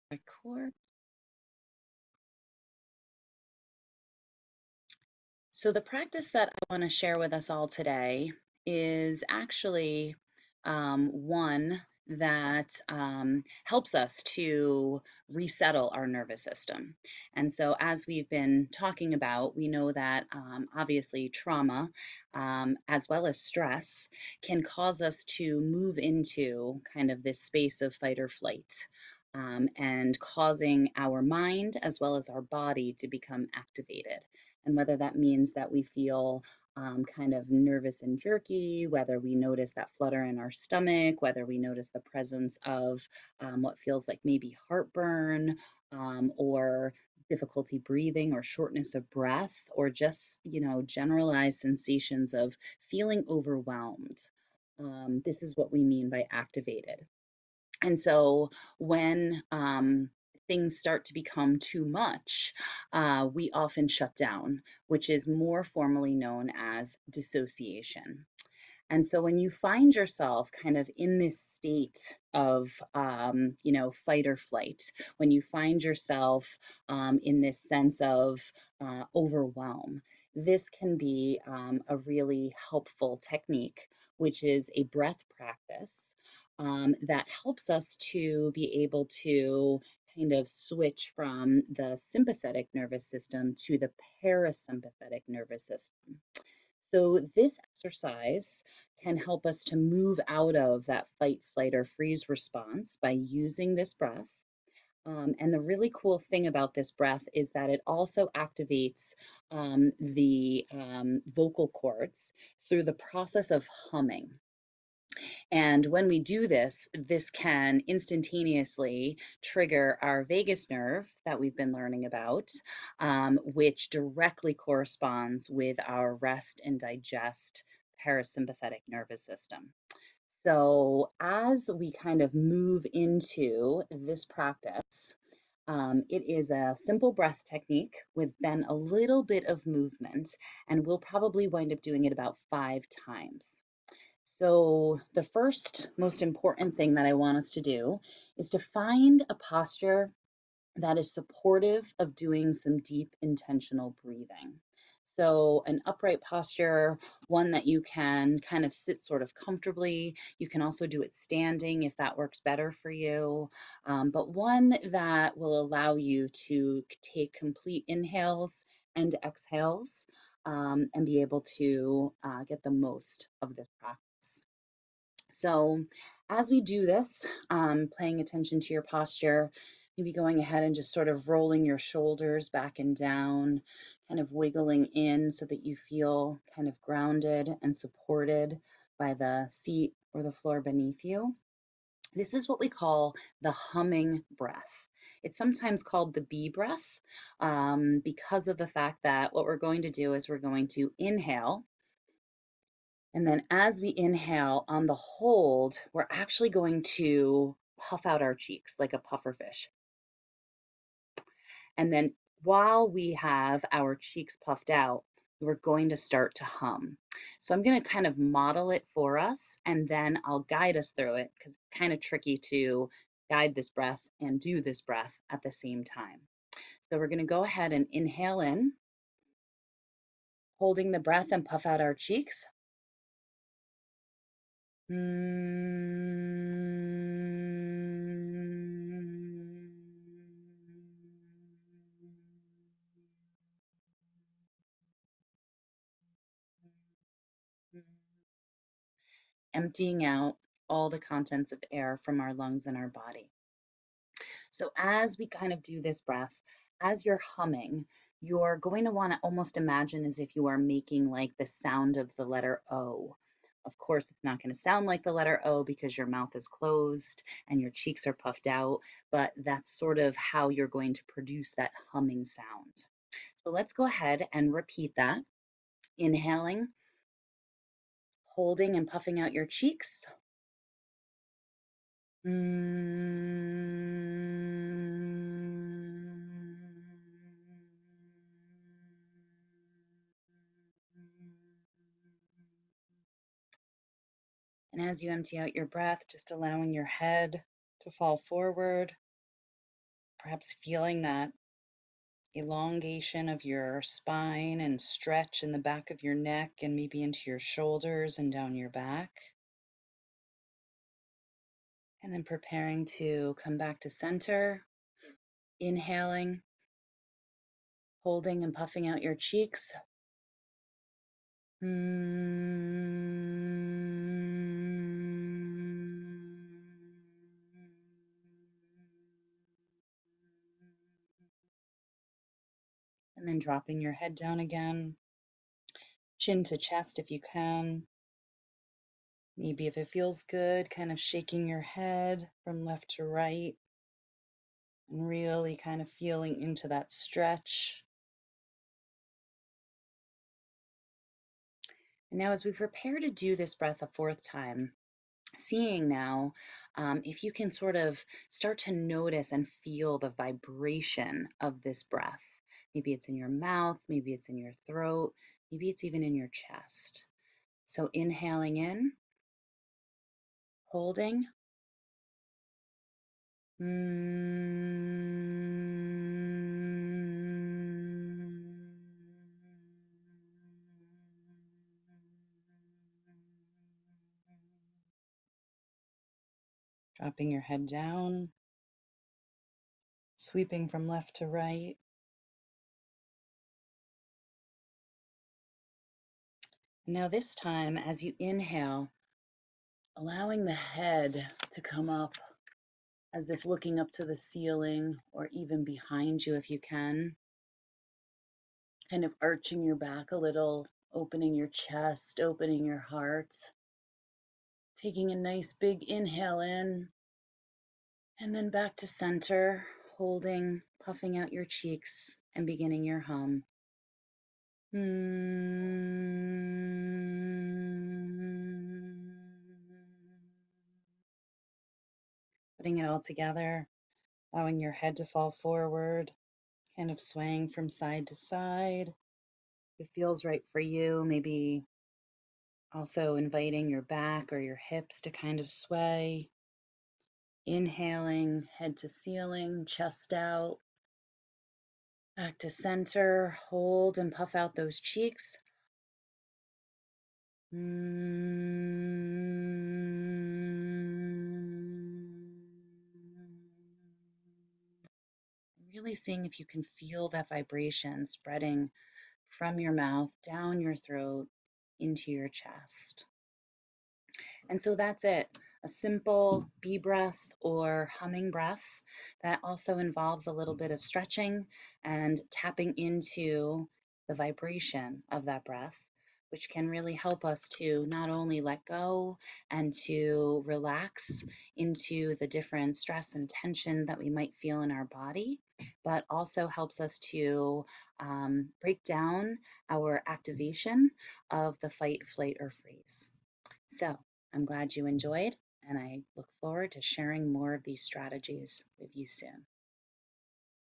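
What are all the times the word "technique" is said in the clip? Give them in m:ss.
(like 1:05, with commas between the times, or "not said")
1:23, 2:17.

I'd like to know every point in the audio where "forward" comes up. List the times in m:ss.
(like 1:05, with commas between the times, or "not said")
4:58, 7:15, 8:26.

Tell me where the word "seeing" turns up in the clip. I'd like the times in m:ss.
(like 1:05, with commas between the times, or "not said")
5:55, 7:45.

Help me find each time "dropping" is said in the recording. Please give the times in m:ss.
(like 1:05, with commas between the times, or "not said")
5:33, 6:26.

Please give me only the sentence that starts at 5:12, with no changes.
And then preparing to come back to center, inhaling, holding and puffing out your cheeks.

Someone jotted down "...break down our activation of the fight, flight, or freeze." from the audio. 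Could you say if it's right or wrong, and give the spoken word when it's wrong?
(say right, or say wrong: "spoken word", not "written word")
right.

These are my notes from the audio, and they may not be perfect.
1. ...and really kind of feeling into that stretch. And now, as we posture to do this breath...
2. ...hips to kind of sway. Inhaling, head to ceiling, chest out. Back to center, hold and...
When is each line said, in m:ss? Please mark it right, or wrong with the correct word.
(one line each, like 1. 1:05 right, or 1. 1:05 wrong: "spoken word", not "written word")
1. 5:44 wrong: "prepare", not "posture"
2. 7:24 right.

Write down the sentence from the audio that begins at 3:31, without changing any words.
And then while we have our cheeks puffed out, we're going to start to hum.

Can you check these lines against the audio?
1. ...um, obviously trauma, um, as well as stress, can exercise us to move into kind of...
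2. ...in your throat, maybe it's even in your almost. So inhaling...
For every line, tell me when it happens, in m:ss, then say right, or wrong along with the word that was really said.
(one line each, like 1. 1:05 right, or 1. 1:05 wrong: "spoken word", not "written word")
1. 0:20 wrong: "cause", not "exercise"
2. 6:04 wrong: "chest", not "almost".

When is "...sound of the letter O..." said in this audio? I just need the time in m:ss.
4:21.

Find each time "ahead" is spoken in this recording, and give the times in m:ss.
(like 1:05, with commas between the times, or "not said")
3:00, 3:47, 4:33.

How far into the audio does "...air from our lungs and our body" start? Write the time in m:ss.
4:11.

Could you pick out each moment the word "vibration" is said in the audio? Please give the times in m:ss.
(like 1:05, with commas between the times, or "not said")
6:00, 7:47, 8:04.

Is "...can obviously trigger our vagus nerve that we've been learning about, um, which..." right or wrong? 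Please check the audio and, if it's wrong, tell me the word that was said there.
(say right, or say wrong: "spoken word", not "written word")
wrong: "instantaneously", not "obviously".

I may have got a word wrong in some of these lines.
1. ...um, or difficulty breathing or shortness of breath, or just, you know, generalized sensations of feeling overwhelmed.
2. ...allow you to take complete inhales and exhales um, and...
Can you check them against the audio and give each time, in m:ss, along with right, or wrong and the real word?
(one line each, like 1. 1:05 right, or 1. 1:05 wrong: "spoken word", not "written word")
1. 0:45 right
2. 2:45 right.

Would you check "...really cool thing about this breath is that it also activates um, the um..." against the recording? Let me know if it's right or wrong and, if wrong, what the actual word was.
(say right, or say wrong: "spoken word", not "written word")
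right.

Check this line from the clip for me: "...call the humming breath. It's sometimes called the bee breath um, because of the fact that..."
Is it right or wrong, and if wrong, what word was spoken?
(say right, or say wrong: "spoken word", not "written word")
right.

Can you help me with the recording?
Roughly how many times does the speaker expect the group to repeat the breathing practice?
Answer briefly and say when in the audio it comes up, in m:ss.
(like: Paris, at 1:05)
5, at 2:22.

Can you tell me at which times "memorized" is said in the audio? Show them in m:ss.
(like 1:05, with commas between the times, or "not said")
not said.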